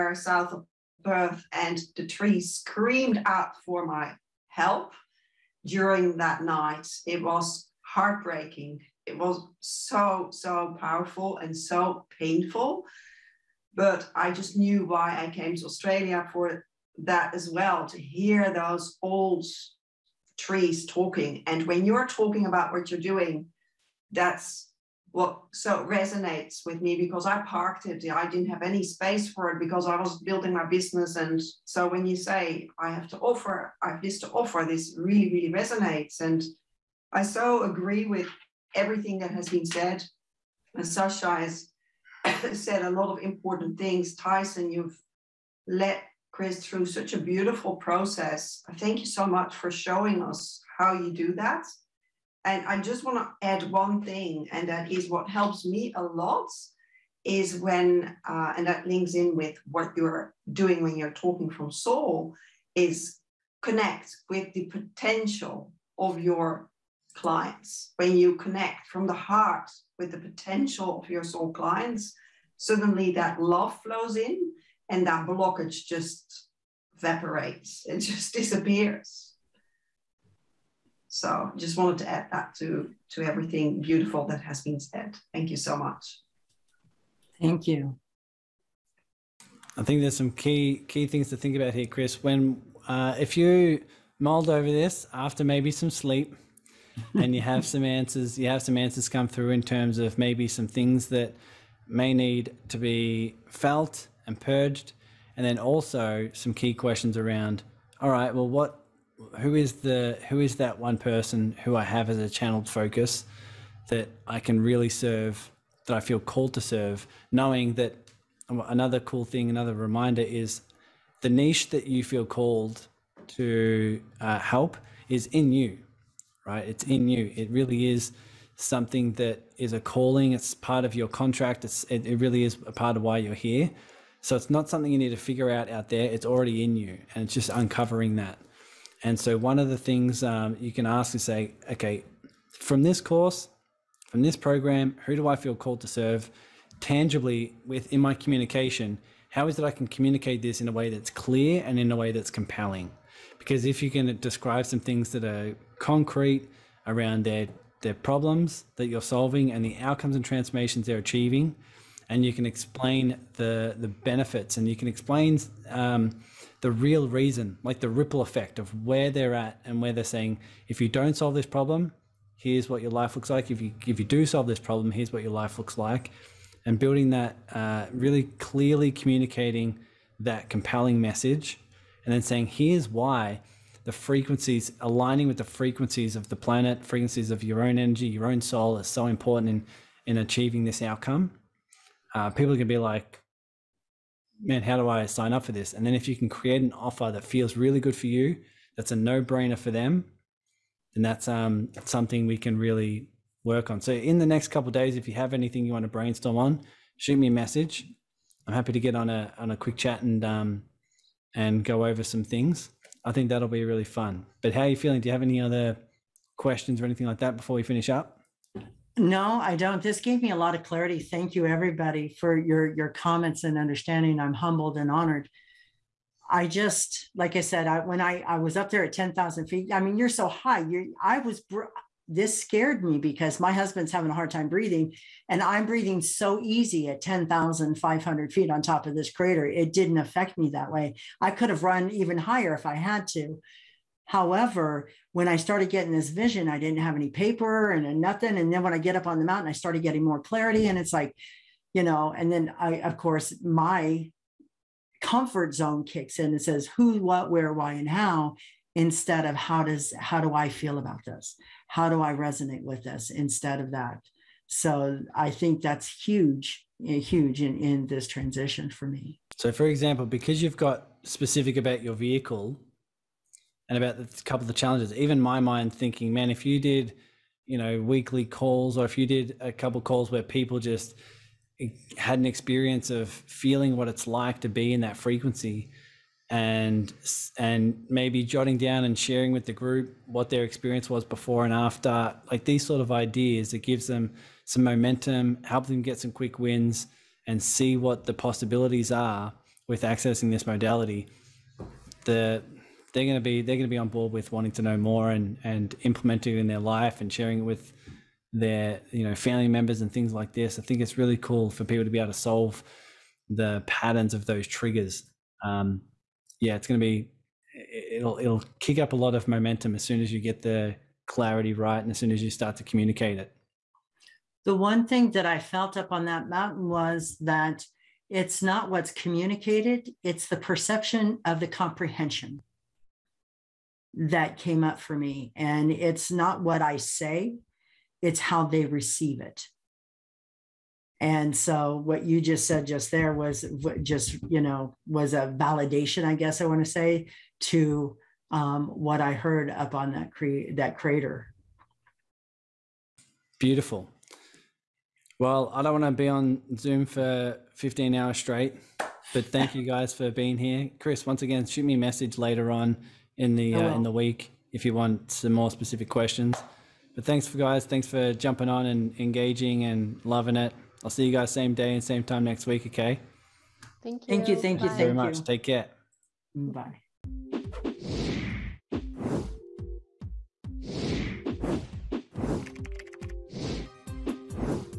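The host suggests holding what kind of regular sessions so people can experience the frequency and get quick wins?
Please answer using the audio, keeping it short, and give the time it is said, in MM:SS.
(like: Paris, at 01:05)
Weekly calls, at 04:37.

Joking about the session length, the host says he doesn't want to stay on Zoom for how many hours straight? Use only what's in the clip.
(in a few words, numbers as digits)
15.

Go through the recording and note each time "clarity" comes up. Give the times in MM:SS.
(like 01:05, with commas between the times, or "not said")
03:40, 04:10, 05:21.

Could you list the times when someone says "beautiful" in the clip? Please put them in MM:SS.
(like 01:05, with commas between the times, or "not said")
00:47, 01:23, 05:53.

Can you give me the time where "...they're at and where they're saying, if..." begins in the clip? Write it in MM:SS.
02:49.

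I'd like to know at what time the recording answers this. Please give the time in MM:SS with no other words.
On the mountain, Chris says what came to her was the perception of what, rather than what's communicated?
05:31.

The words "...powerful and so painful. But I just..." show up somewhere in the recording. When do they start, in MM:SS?
00:10.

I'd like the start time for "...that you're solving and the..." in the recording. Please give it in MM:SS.
02:38.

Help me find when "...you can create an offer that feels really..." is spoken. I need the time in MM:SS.
03:16.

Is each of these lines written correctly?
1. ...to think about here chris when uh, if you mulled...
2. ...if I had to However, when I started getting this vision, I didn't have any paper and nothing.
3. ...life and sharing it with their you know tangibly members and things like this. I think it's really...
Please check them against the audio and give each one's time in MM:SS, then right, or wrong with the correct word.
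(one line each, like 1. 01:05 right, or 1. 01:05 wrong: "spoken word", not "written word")
1. 01:31 right
2. 04:02 right
3. 05:06 wrong: "family", not "tangibly".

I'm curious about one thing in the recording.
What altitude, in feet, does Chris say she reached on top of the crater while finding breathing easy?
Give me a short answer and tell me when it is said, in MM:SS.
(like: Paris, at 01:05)
10,500 feet, at 03:57.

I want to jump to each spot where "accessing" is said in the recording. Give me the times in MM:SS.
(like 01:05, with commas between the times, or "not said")
04:59.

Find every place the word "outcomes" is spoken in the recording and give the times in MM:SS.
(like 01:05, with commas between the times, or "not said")
02:39, 03:10.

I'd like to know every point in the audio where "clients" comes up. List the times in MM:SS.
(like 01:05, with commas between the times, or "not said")
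01:07, 01:11.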